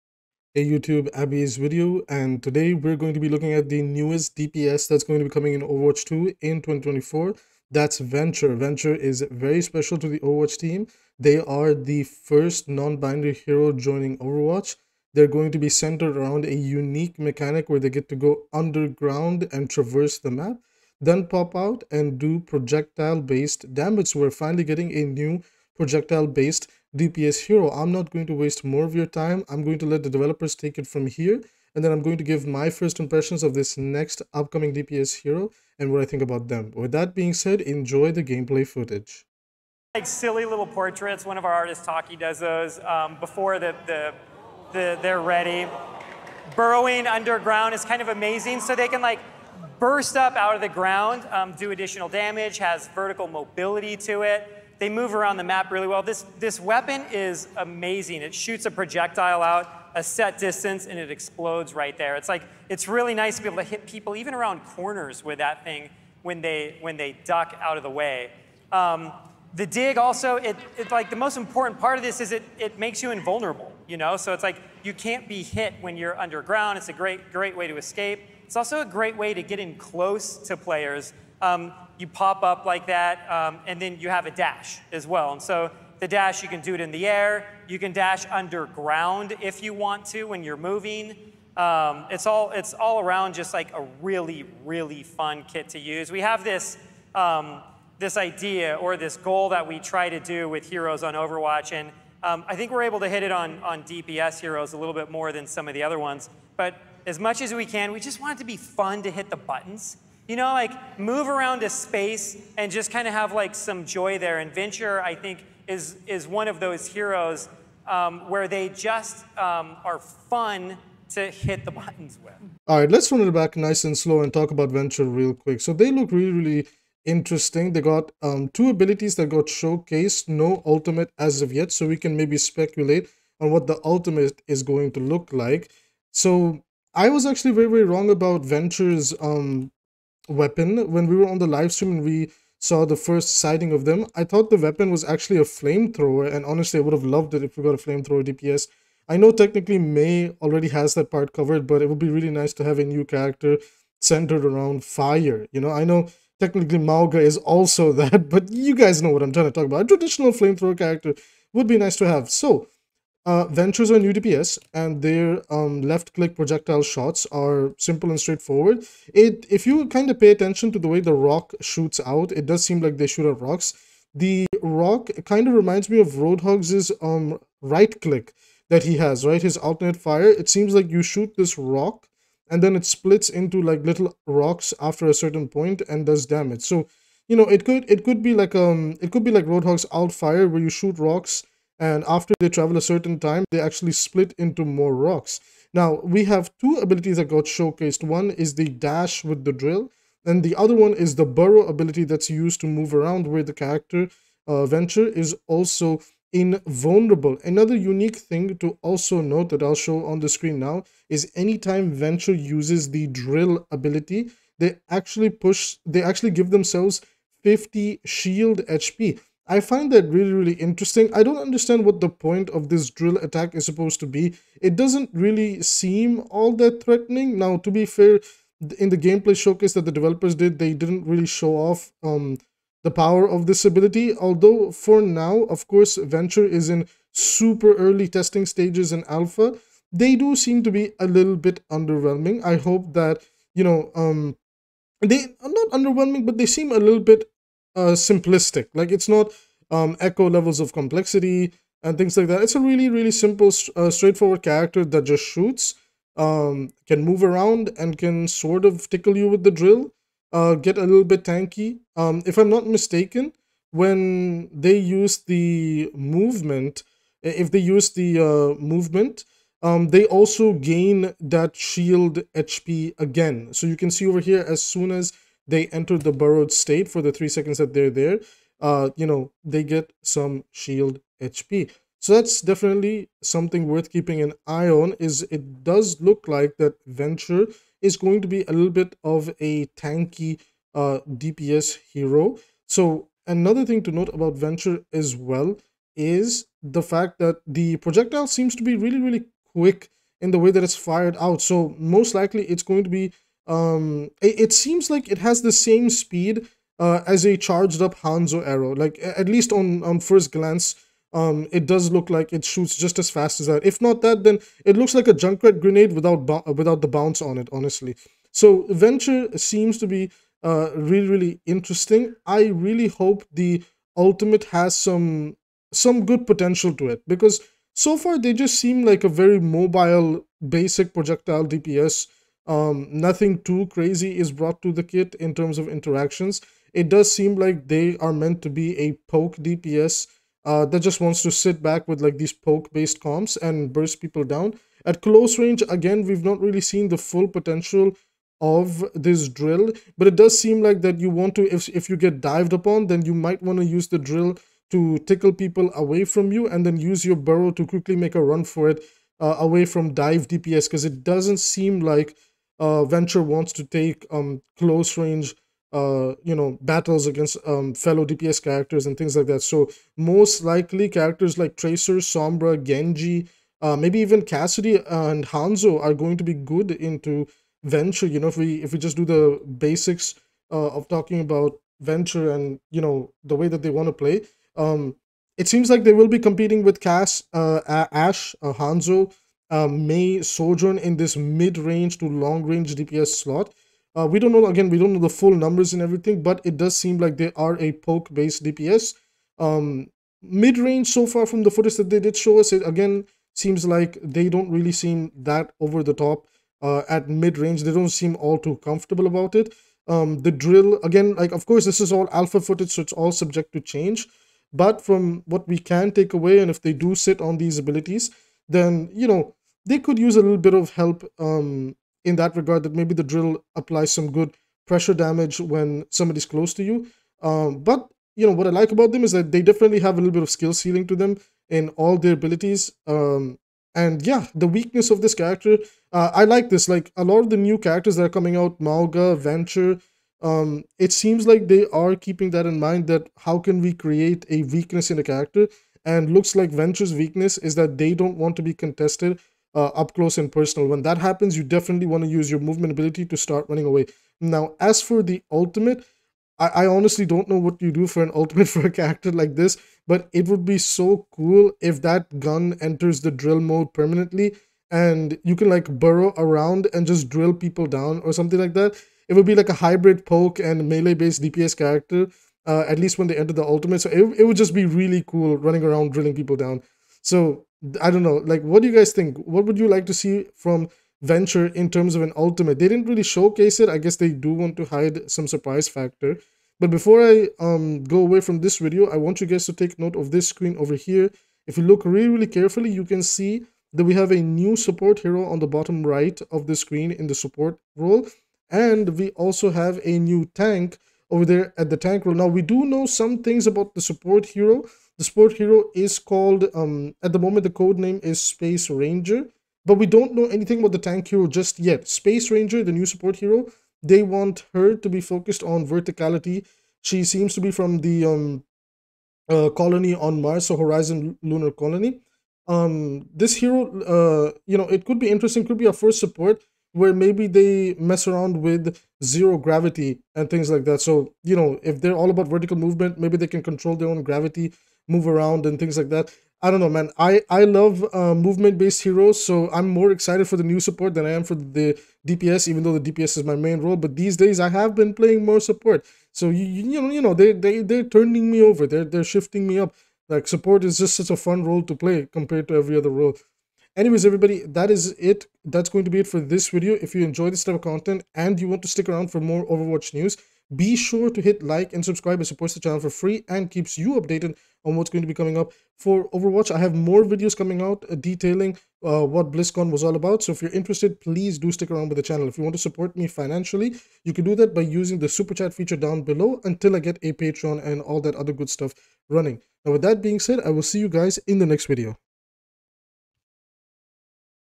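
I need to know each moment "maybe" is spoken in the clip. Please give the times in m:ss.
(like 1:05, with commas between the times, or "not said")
2:12, 6:13, 7:02, 8:46, 8:52.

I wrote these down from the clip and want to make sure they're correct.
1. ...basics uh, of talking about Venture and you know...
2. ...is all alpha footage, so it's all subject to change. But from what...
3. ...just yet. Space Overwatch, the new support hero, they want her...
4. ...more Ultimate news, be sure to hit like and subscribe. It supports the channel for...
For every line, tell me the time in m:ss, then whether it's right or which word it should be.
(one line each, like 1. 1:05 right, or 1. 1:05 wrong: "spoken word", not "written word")
1. 6:19 right
2. 6:51 right
3. 8:31 wrong: "Ranger", not "Overwatch"
4. 9:19 wrong: "Overwatch", not "Ultimate".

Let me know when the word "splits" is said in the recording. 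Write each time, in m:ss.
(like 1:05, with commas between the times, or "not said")
3:02, 3:13.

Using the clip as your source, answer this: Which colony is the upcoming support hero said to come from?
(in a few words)
Horizon Lunar Colony.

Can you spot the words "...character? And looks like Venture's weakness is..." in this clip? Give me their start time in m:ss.
7:25.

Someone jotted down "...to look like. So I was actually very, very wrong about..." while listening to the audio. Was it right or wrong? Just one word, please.
right.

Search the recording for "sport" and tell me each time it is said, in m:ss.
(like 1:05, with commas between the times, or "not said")
8:25.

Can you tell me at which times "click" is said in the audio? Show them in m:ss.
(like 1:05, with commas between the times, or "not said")
2:45, 2:57.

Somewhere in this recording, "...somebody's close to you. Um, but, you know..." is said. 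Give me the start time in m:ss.
7:05.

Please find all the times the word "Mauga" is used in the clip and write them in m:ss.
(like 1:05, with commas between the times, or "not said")
2:36, 7:18.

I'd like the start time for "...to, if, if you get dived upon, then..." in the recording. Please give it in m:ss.
5:51.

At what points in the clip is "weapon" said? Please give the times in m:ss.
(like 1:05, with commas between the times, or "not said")
0:56, 2:20, 2:24.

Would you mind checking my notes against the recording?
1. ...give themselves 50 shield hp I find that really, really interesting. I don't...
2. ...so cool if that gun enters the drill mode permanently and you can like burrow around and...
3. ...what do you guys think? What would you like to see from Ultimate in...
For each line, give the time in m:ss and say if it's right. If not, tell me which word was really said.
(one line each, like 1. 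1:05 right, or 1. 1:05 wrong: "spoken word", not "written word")
1. 3:36 right
2. 7:40 right
3. 7:58 wrong: "Venture", not "Ultimate".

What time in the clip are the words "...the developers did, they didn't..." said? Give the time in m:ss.
3:49.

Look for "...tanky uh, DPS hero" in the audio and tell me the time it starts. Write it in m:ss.
4:49.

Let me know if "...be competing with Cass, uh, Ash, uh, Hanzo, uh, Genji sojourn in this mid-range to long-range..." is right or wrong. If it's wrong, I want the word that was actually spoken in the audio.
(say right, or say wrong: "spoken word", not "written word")
wrong: "Mei", not "Genji".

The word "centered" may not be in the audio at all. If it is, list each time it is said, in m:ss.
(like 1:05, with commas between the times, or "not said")
0:15, 2:33.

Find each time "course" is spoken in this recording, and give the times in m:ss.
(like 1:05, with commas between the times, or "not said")
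3:55, 6:51.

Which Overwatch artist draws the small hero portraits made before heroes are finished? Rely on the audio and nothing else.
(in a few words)
Taki.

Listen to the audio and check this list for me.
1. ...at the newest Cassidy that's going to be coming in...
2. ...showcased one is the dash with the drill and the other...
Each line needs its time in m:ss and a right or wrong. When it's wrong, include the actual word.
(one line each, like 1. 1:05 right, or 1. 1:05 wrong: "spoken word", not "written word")
1. 0:03 wrong: "DPS", not "Cassidy"
2. 3:17 right.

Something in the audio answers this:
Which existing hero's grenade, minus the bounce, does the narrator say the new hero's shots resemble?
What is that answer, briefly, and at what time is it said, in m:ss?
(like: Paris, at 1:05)
Junkrat, at 5:15.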